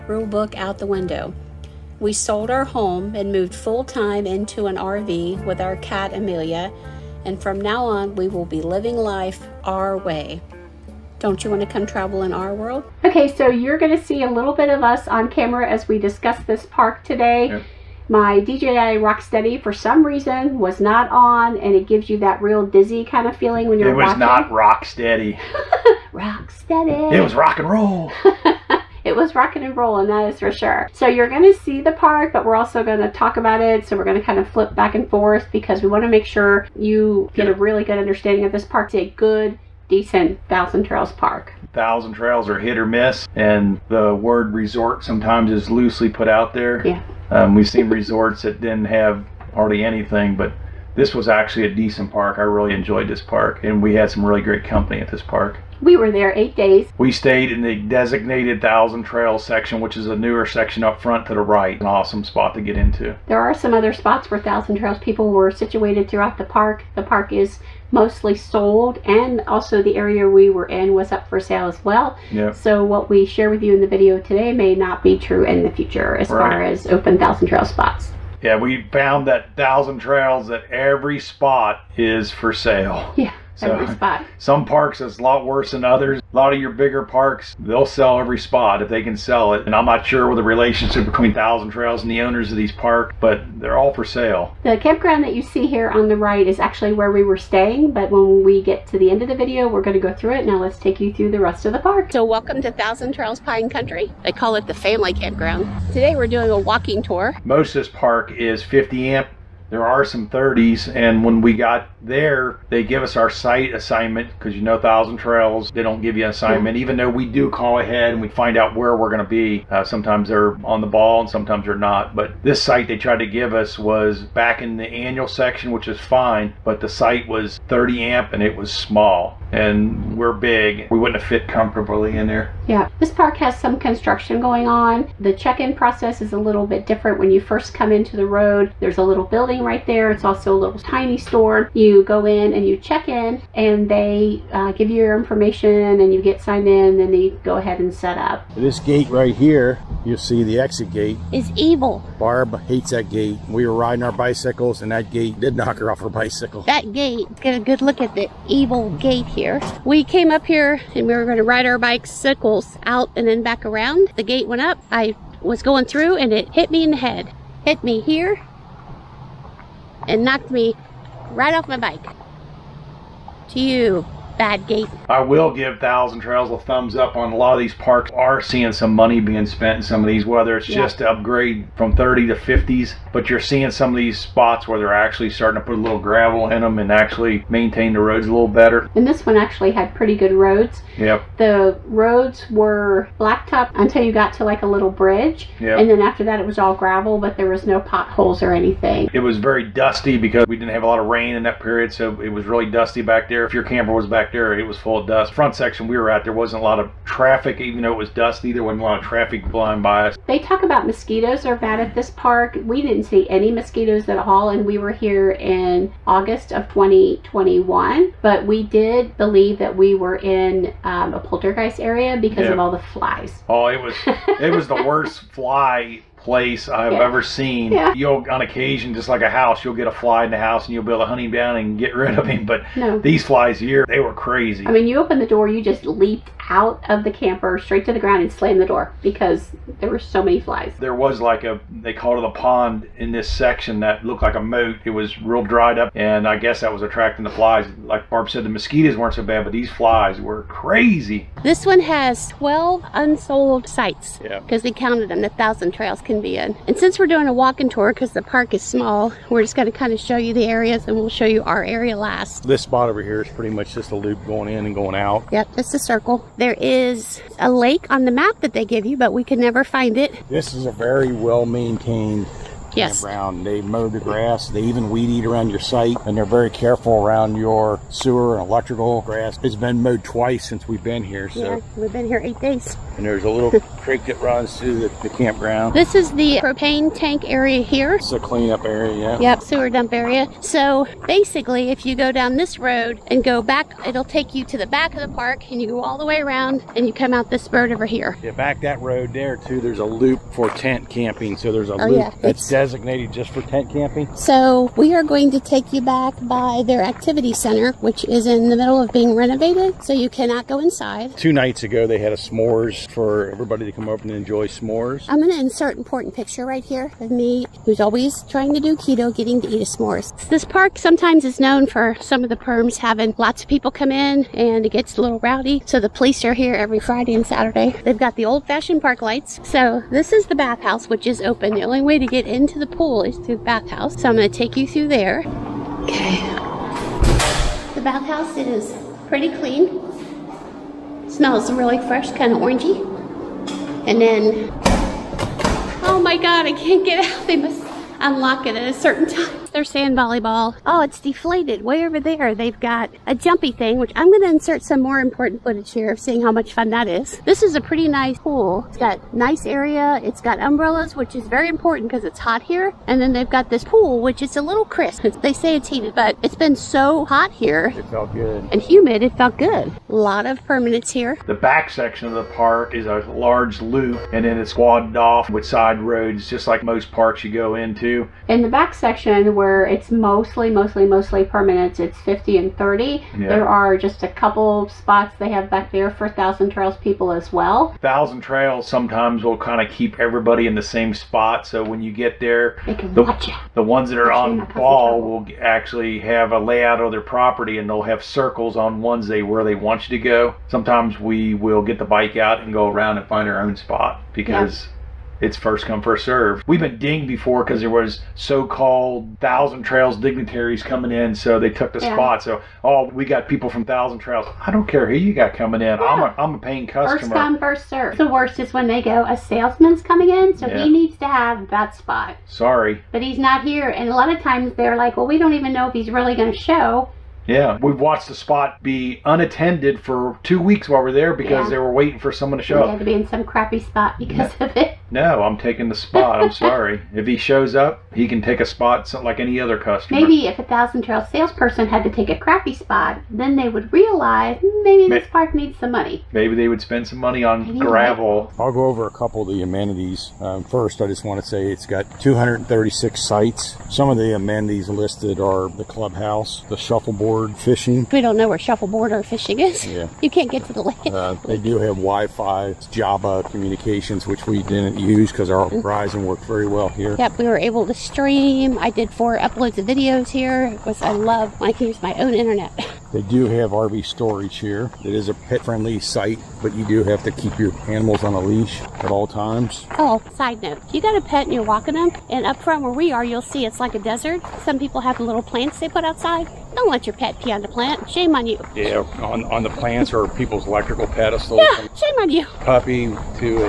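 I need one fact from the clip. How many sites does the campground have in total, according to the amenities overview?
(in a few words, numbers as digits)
236.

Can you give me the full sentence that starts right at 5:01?
So there's a oh, loop yeah, that's designated just for tent camping.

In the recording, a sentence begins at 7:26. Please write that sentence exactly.
Maybe they would spend some money on maybe gravel.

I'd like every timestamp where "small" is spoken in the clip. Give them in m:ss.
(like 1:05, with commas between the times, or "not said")
2:08, 4:18.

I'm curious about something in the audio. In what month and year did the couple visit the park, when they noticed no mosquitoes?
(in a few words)
August 2021.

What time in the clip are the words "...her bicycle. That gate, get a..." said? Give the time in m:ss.
2:36.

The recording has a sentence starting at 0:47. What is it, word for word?
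Um, we've seen resorts that didn't have hardly anything, but this was actually a decent park.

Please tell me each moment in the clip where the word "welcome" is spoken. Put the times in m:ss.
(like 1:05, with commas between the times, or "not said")
1:42.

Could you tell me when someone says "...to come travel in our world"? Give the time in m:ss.
0:11.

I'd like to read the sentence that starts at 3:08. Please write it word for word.
And this one actually had pretty good roads.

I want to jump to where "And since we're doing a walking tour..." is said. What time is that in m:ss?
4:16.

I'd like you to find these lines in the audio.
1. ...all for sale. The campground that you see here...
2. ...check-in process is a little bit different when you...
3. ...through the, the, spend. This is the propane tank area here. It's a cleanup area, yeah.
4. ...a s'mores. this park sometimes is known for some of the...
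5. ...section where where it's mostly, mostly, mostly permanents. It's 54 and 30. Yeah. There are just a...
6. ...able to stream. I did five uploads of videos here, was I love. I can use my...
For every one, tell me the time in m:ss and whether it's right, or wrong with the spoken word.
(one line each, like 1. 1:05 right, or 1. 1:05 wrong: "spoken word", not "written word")
1. 1:33 right
2. 2:15 right
3. 4:44 wrong: "campground", not "spend"
4. 5:19 right
5. 6:18 wrong: "50", not "54"
6. 7:47 wrong: "four", not "five".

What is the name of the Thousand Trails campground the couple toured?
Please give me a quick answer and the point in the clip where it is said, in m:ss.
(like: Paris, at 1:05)
Pine Country, at 1:43.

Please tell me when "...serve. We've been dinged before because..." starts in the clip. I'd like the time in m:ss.
6:46.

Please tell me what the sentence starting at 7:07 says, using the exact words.
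Yeah, we have watched the spot be unattended for two weeks while we're there because yeah.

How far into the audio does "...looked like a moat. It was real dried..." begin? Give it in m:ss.
4:04.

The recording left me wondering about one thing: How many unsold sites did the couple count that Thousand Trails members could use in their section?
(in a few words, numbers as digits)
12.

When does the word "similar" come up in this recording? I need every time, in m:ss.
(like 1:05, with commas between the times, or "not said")
not said.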